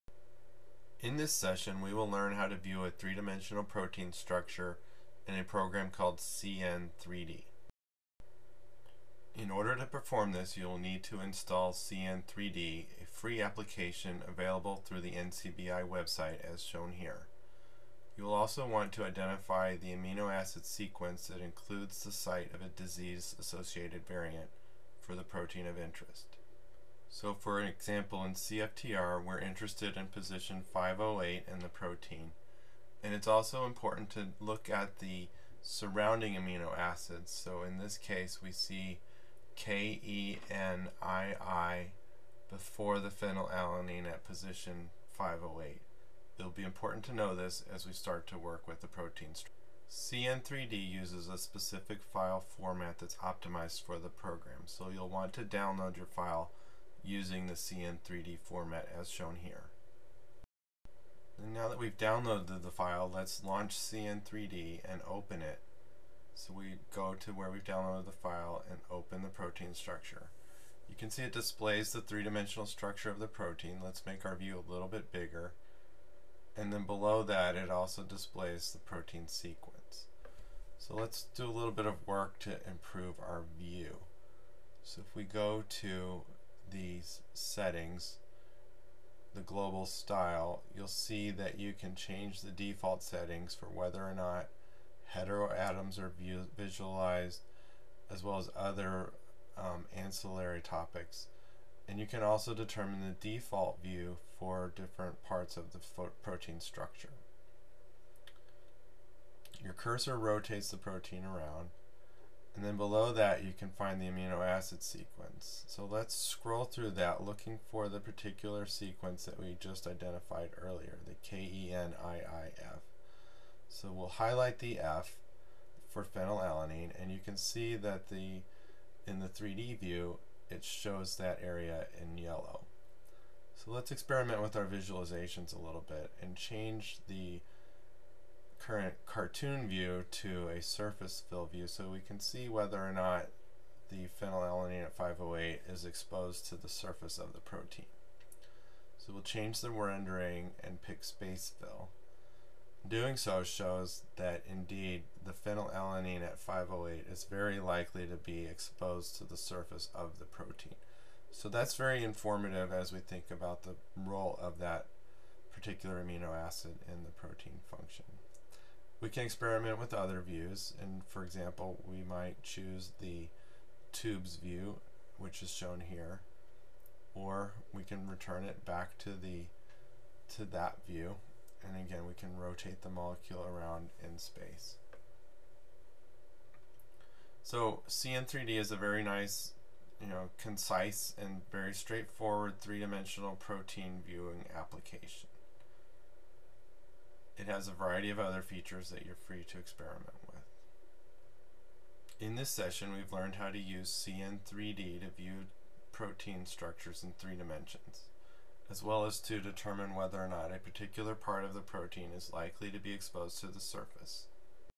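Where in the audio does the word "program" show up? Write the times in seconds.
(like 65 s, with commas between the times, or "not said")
5 s, 54 s.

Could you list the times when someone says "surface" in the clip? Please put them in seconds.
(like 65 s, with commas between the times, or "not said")
140 s, 146 s, 159 s, 213 s.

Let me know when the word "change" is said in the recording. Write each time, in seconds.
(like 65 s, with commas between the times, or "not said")
91 s, 136 s, 149 s.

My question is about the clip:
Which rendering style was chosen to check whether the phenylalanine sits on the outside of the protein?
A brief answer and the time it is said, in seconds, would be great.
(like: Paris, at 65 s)
Space fill, at 151 s.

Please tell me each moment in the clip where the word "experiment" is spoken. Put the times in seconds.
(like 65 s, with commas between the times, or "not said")
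133 s, 169 s, 199 s.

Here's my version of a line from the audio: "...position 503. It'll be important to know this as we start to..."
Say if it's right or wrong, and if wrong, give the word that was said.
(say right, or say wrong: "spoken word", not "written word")
wrong: "508", not "503".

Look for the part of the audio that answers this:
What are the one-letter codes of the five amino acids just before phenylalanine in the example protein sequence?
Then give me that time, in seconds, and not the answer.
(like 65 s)
39 s.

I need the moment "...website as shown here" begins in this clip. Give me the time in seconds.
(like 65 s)
15 s.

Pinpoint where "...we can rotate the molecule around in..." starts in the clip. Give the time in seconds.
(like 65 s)
182 s.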